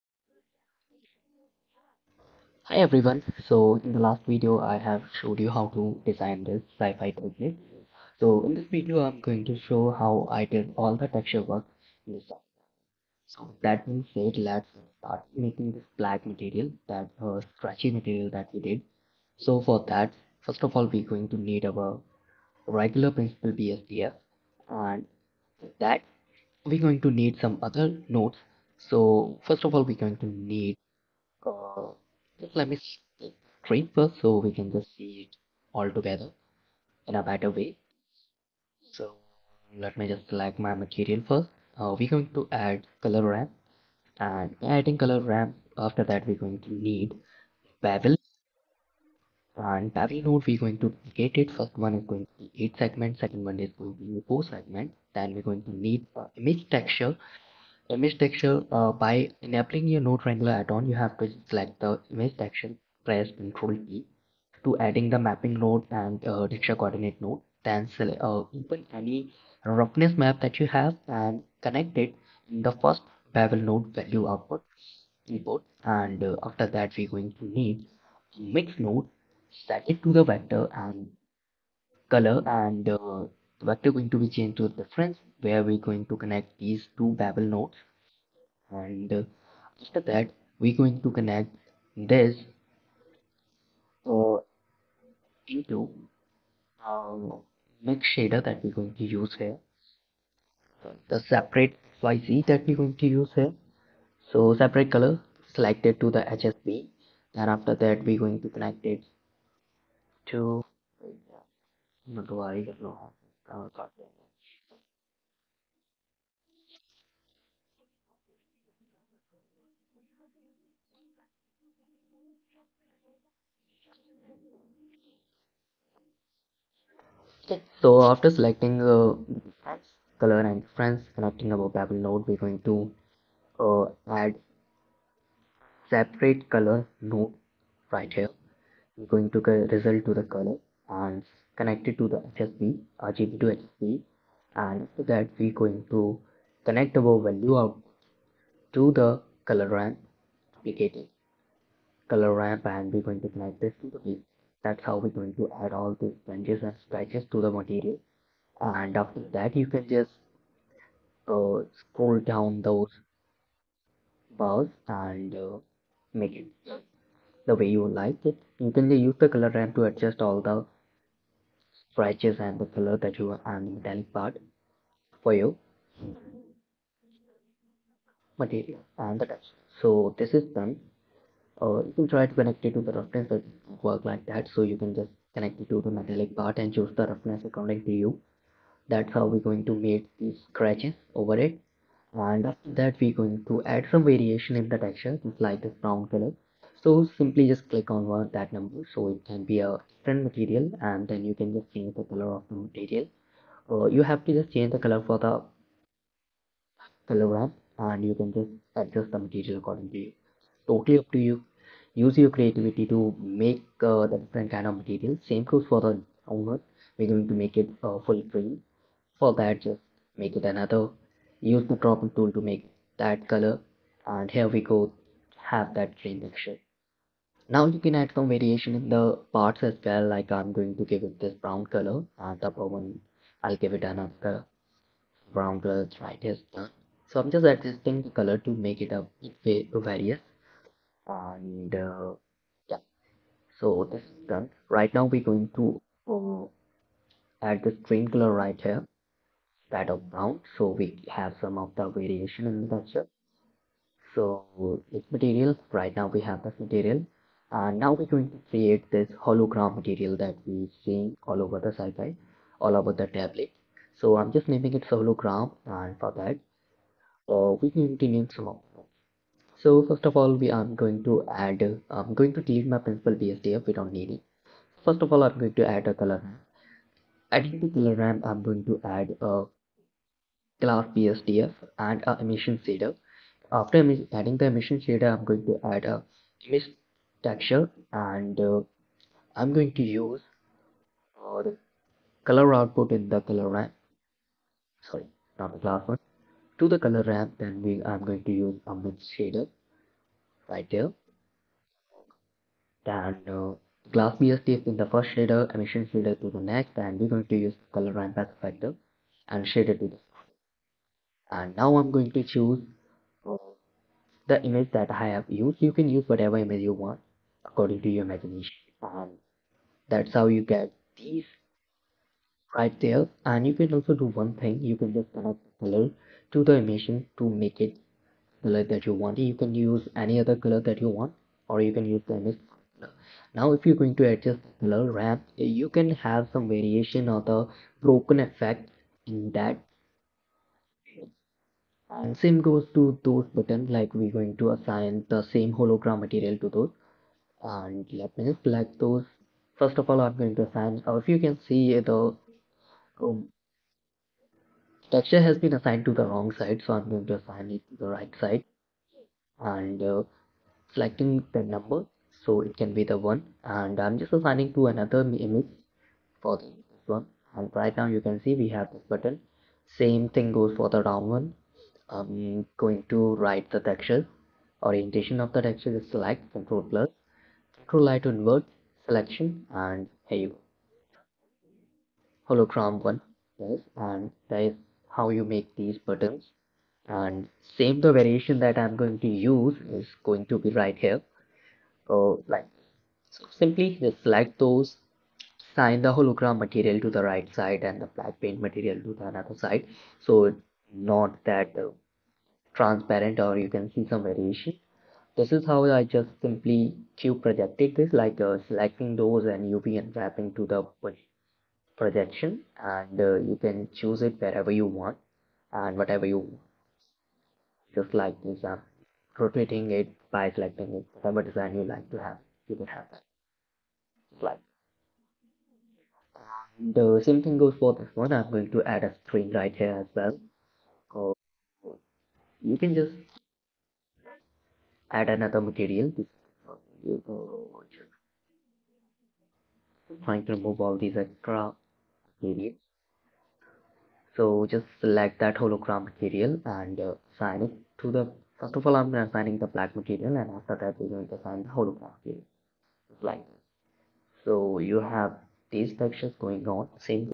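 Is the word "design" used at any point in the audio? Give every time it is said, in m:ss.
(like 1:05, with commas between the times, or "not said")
0:06, 7:01.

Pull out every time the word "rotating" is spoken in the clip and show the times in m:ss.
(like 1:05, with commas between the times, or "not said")
6:59.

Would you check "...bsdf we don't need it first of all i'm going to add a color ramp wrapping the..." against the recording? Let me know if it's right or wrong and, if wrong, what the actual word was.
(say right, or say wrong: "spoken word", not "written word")
wrong: "adding", not "wrapping".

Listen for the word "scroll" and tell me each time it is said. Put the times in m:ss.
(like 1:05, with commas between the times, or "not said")
2:41, 6:17.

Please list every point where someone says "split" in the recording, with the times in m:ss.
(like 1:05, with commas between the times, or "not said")
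0:32.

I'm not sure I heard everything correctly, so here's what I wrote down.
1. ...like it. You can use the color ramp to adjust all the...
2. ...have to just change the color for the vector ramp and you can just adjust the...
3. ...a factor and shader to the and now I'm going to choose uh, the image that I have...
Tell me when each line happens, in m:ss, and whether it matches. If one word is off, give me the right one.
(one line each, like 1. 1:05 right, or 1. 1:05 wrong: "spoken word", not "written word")
1. 2:47 right
2. 3:24 wrong: "color", not "vector"
3. 5:08 right.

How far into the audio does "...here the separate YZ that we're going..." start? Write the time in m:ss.
1:39.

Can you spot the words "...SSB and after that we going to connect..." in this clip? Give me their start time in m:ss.
2:23.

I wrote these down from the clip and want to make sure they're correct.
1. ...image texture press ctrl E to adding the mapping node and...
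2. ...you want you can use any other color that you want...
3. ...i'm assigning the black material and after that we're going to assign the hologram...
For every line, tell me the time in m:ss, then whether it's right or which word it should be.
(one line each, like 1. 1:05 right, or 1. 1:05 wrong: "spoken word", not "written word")
1. 1:02 right
2. 5:28 right
3. 7:28 right.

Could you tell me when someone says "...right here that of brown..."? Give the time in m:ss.
4:08.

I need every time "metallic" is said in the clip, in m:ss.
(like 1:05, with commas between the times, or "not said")
2:53, 3:05.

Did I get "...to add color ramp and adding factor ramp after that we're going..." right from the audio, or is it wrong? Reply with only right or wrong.
wrong.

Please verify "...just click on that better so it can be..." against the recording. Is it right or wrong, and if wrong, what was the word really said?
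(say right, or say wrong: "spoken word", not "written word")
wrong: "number", not "better".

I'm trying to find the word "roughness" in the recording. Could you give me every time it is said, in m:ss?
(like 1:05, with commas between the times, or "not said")
1:09, 3:02, 3:07.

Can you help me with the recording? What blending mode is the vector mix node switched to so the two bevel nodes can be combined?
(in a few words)
Difference.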